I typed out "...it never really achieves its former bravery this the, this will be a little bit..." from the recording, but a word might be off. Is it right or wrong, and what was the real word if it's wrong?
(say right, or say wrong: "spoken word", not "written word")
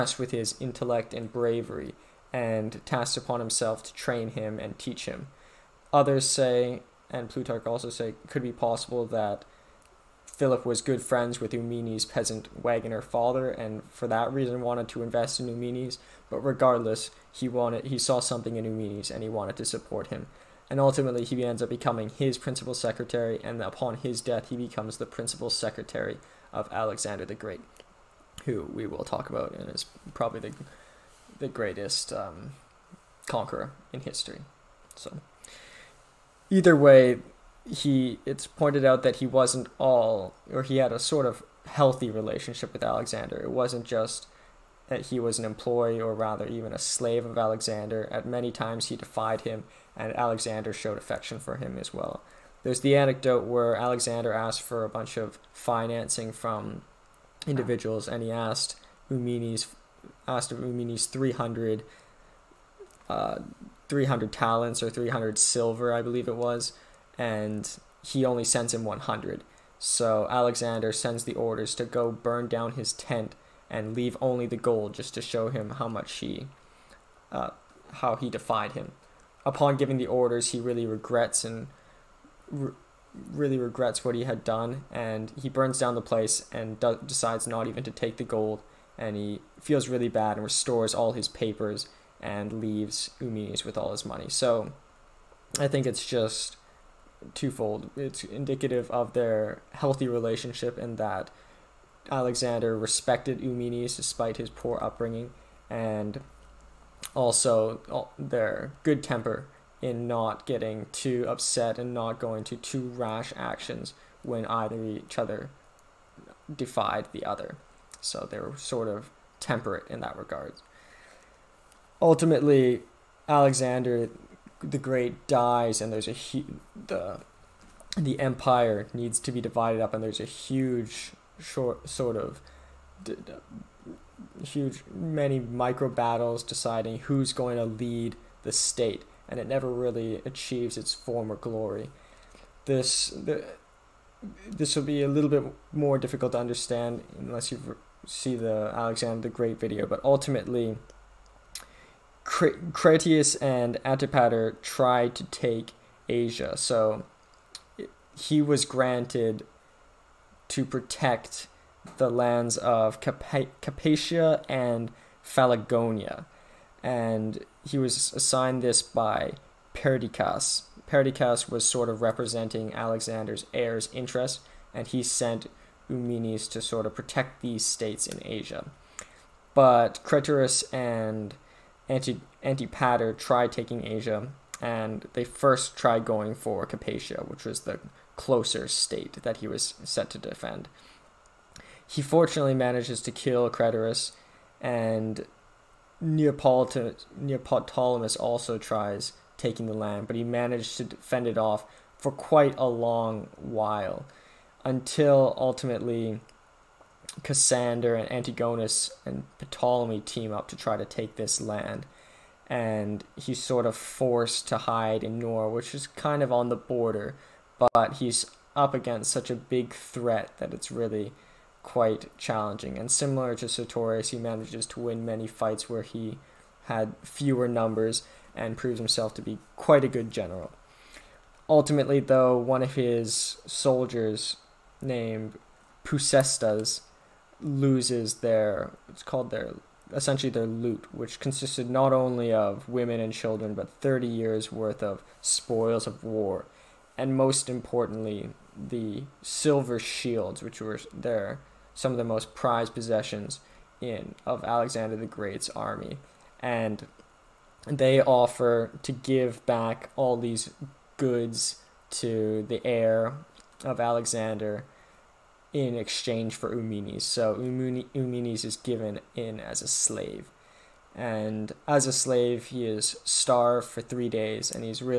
wrong: "glory", not "bravery".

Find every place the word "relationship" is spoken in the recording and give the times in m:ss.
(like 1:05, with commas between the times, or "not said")
0:42, 1:40.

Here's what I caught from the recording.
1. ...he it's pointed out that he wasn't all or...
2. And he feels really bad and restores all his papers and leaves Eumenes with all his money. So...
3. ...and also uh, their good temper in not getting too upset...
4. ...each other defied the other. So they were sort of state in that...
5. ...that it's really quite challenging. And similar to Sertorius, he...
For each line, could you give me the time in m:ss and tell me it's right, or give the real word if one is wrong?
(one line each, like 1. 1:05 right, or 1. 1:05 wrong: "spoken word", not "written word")
1. 0:37 right
2. 1:28 right
3. 1:45 right
4. 1:54 wrong: "temperate", not "state"
5. 3:40 right.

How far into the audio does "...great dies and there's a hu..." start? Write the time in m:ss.
2:04.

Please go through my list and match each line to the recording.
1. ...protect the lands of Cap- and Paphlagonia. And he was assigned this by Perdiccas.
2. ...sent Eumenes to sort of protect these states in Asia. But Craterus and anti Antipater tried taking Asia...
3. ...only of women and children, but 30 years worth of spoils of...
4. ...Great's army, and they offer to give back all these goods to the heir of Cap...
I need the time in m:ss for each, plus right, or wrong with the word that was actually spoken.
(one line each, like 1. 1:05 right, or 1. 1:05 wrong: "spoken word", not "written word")
1. 2:40 right
2. 2:55 right
3. 4:01 right
4. 4:15 wrong: "Alexander", not "Cap".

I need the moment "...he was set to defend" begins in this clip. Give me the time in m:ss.
3:09.